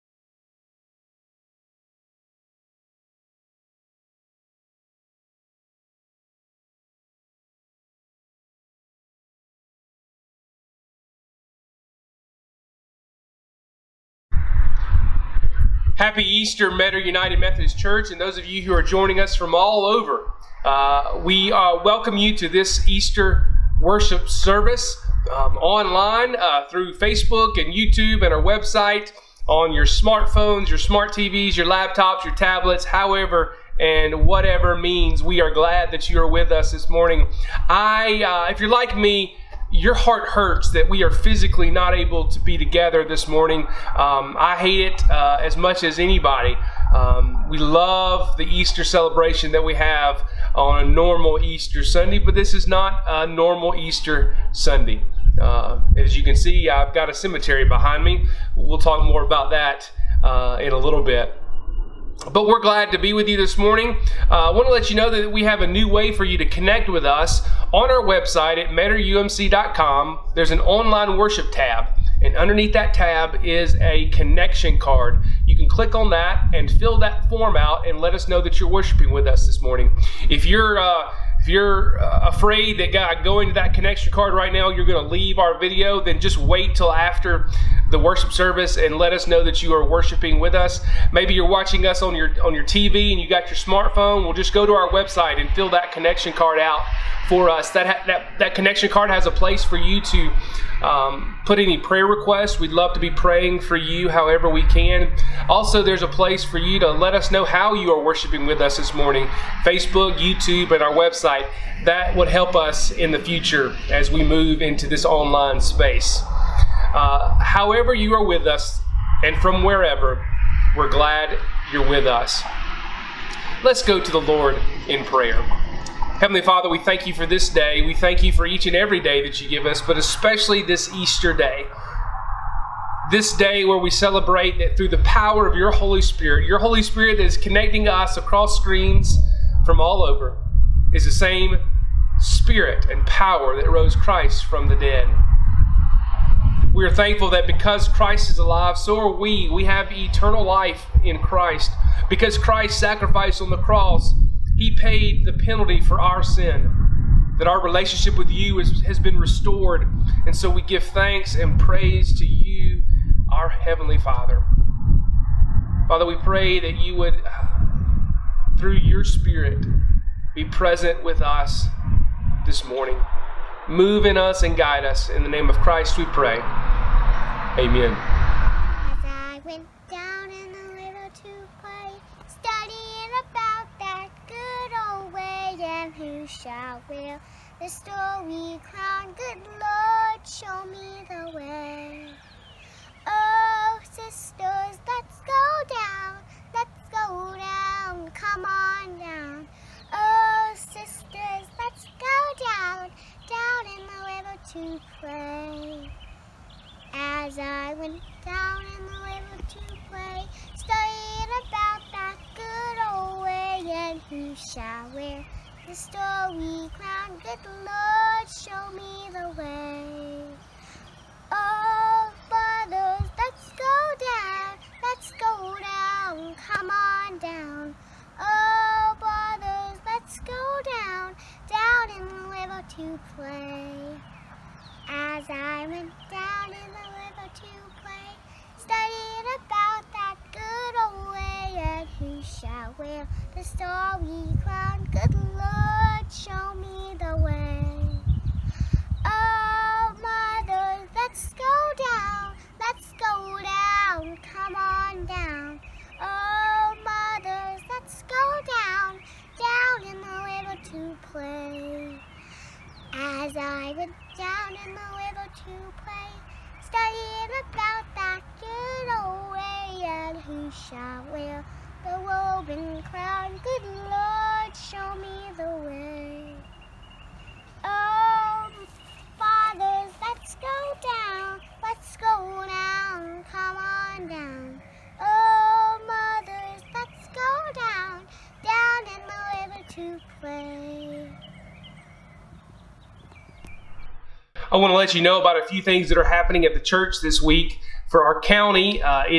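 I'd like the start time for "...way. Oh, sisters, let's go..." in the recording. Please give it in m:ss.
3:11.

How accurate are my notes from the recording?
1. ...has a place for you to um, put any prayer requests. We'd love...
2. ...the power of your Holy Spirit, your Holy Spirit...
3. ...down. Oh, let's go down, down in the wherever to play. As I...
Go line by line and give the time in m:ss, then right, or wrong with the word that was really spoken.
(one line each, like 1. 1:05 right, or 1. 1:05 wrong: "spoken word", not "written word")
1. 1:39 right
2. 2:14 right
3. 3:47 wrong: "river", not "wherever".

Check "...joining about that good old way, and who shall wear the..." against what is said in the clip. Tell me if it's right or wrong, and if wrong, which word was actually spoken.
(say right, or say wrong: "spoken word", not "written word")
wrong: "studying", not "joining".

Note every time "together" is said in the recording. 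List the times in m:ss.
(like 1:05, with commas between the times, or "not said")
0:42.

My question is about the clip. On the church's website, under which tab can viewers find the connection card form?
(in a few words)
Online worship.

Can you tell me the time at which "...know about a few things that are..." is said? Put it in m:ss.
4:55.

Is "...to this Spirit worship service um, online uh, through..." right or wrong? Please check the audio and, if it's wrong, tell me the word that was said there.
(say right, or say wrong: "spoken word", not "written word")
wrong: "Easter", not "Spirit".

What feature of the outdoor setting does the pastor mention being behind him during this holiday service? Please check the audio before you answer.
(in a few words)
A cemetery.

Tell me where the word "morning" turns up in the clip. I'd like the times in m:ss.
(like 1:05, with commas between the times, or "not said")
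0:36, 0:43, 1:03, 1:19, 1:48, 2:52.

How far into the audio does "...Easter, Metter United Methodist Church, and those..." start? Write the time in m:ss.
0:16.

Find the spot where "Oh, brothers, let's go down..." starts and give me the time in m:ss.
3:41.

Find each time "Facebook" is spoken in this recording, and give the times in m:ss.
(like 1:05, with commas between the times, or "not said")
0:26, 1:49.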